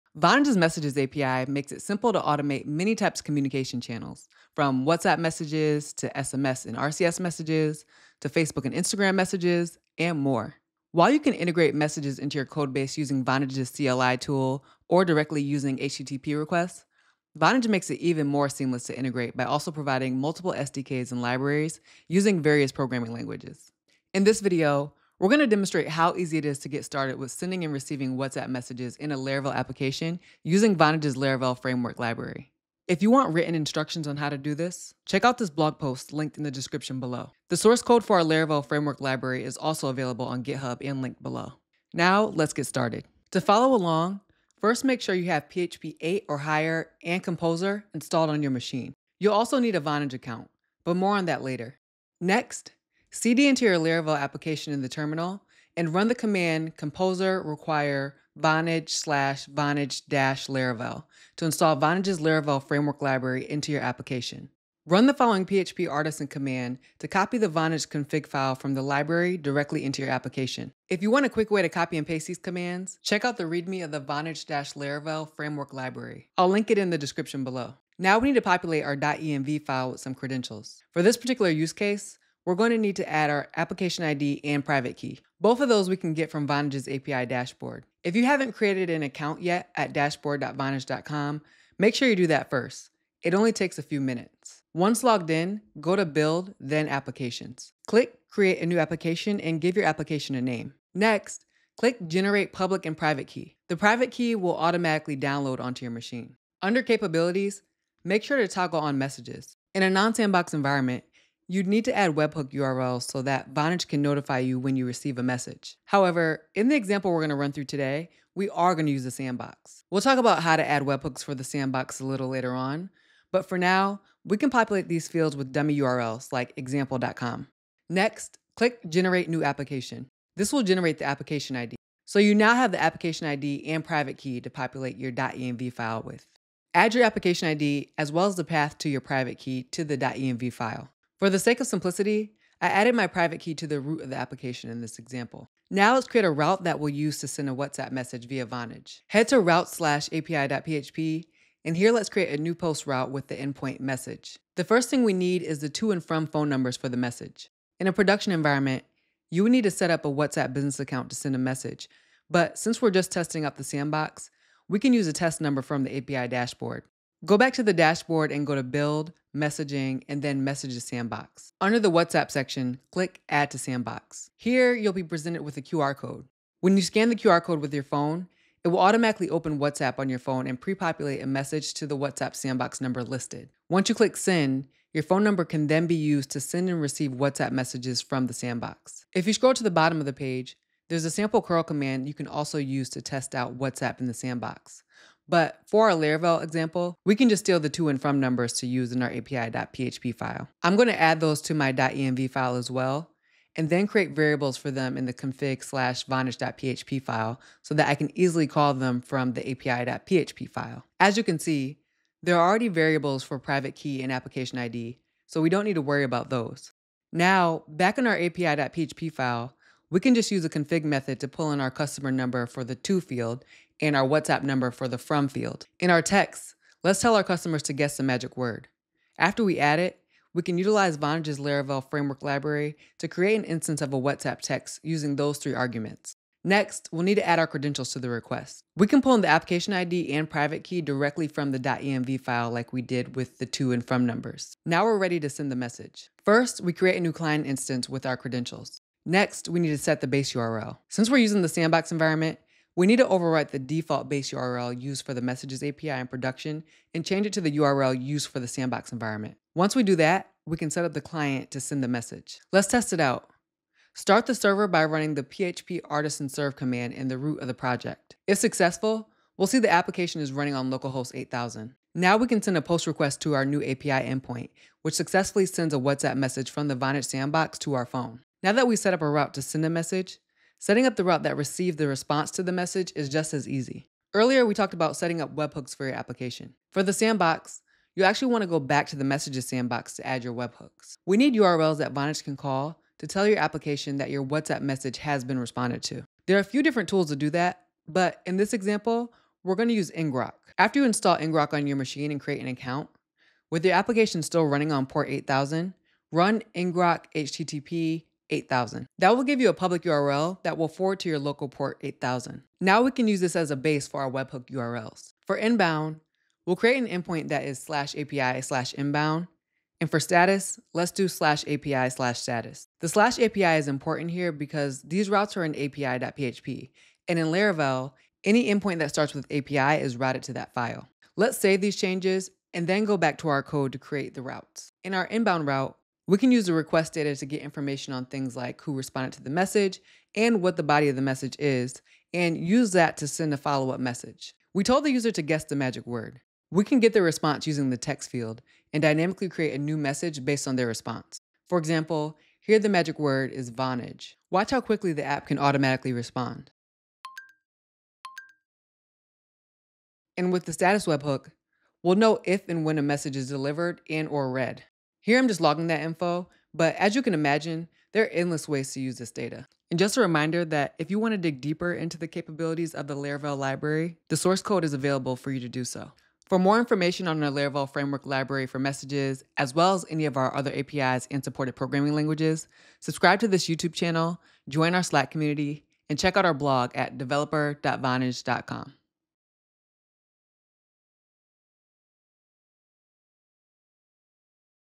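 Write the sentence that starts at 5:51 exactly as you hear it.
For example, here the magic word is Vonage.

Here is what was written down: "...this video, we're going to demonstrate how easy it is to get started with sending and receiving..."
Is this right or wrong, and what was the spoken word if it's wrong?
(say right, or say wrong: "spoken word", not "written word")
right.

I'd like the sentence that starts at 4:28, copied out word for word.
If successful, we'll see the application is running on localhost 8000.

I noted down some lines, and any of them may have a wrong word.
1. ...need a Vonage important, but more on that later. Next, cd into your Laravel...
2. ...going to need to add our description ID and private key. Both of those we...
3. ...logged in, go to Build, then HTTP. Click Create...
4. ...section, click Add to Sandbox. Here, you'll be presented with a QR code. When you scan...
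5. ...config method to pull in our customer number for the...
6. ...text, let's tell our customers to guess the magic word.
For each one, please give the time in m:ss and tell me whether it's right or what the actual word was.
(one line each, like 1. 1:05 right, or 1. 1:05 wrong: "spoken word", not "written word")
1. 0:49 wrong: "account", not "important"
2. 1:22 wrong: "application", not "description"
3. 1:35 wrong: "Applications", not "HTTP"
4. 2:52 right
5. 3:40 right
6. 3:46 right.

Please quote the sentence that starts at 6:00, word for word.
And with the status webhook, we'll know if and when a message is delivered and or read.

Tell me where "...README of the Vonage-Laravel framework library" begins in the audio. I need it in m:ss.
1:13.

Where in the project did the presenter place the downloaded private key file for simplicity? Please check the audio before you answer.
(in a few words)
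root of the application.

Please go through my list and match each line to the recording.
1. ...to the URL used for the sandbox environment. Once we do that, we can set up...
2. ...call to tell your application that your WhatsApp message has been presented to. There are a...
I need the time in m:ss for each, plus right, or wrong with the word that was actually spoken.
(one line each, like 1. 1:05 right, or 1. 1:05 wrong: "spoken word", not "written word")
1. 4:17 right
2. 4:52 wrong: "responded", not "presented".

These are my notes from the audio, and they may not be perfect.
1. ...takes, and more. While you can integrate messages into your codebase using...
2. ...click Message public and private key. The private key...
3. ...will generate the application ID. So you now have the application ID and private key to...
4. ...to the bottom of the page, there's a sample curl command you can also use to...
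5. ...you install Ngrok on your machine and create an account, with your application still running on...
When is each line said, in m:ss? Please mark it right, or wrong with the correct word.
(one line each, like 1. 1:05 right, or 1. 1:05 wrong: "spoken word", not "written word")
1. 0:09 wrong: "messages", not "takes"
2. 1:41 wrong: "Generate", not "Message"
3. 2:10 right
4. 3:09 right
5. 5:00 right.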